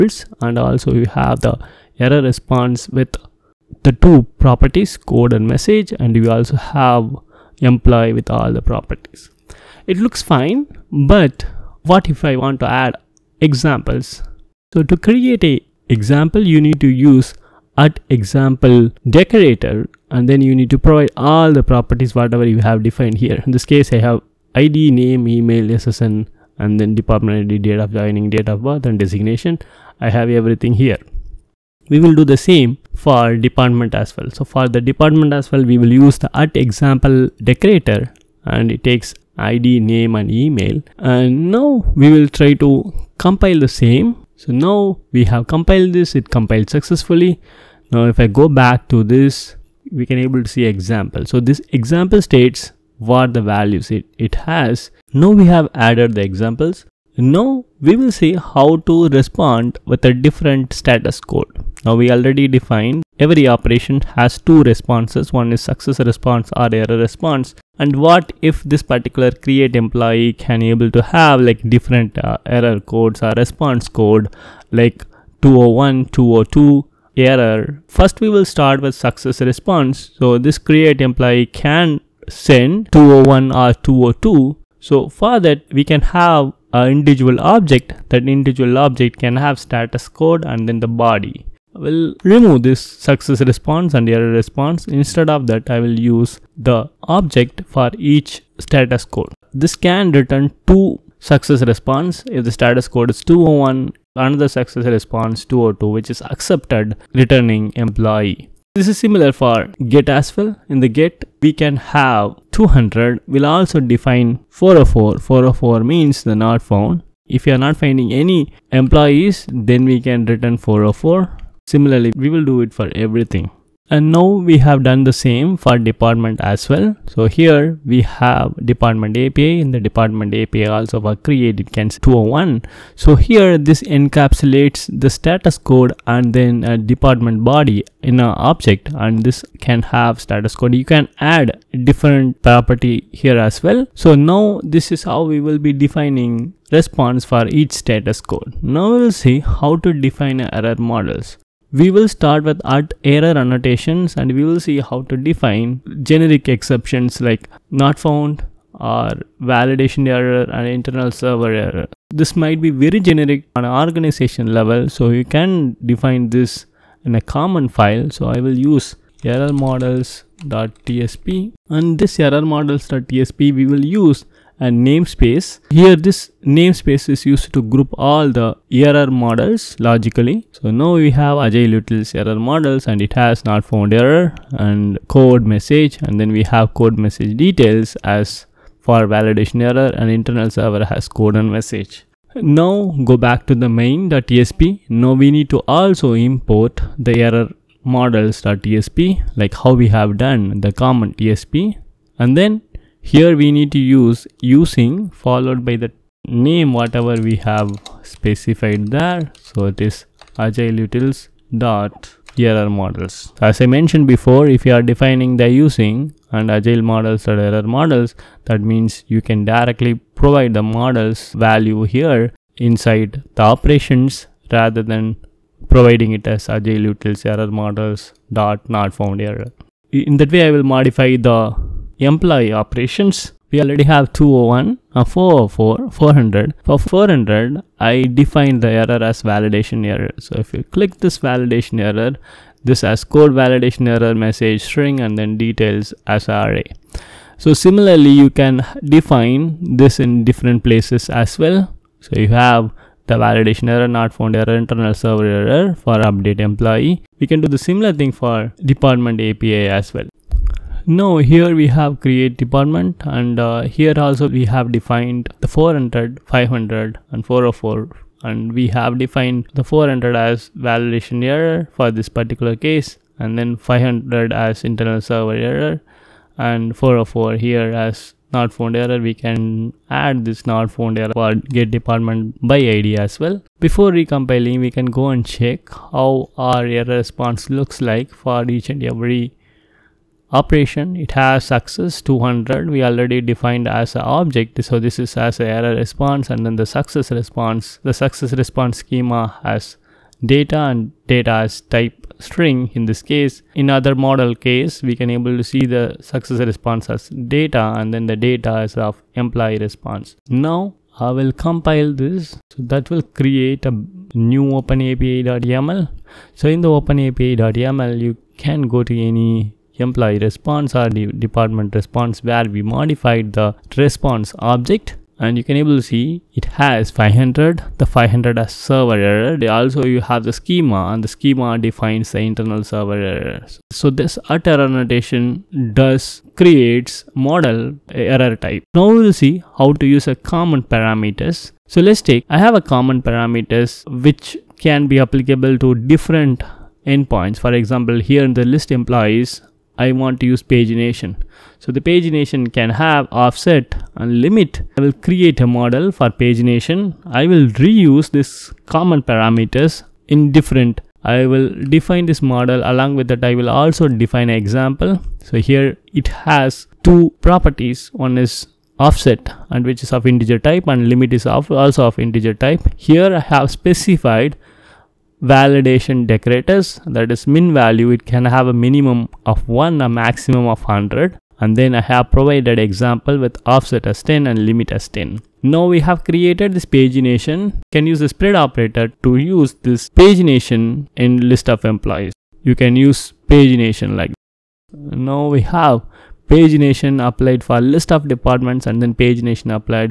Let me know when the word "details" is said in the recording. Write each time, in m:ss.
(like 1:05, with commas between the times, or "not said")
3:07, 4:05.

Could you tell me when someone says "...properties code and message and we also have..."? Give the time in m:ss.
0:04.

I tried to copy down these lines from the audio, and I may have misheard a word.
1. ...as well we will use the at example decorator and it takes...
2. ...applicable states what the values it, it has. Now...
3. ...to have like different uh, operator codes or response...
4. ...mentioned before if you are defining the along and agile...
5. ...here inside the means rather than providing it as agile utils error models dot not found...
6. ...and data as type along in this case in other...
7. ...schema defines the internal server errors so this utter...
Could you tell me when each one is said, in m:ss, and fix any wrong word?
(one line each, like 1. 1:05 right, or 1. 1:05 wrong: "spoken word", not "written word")
1. 0:35 right
2. 0:51 wrong: "example", not "applicable"
3. 1:10 wrong: "error", not "operator"
4. 3:33 wrong: "using", not "along"
5. 3:41 wrong: "operations", not "means"
6. 5:00 wrong: "string", not "along"
7. 5:31 right.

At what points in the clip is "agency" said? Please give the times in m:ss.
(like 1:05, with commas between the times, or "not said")
not said.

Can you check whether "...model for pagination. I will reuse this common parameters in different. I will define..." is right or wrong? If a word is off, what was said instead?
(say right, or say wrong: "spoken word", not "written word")
right.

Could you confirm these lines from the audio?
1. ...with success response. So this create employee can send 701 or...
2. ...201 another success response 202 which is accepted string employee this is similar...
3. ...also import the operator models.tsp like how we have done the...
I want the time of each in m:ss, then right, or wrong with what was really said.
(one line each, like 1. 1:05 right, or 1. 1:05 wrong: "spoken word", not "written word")
1. 1:18 wrong: "201", not "701"
2. 1:43 wrong: "returning", not "string"
3. 3:15 wrong: "error", not "operator".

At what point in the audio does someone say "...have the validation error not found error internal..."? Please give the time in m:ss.
4:12.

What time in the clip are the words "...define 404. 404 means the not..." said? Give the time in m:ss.
1:53.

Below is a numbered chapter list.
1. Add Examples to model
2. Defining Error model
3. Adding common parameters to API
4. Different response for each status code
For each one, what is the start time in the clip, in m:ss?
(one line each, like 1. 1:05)
1. 0:09
2. 2:28
3. 5:37
4. 1:03.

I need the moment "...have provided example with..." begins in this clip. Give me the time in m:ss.
6:21.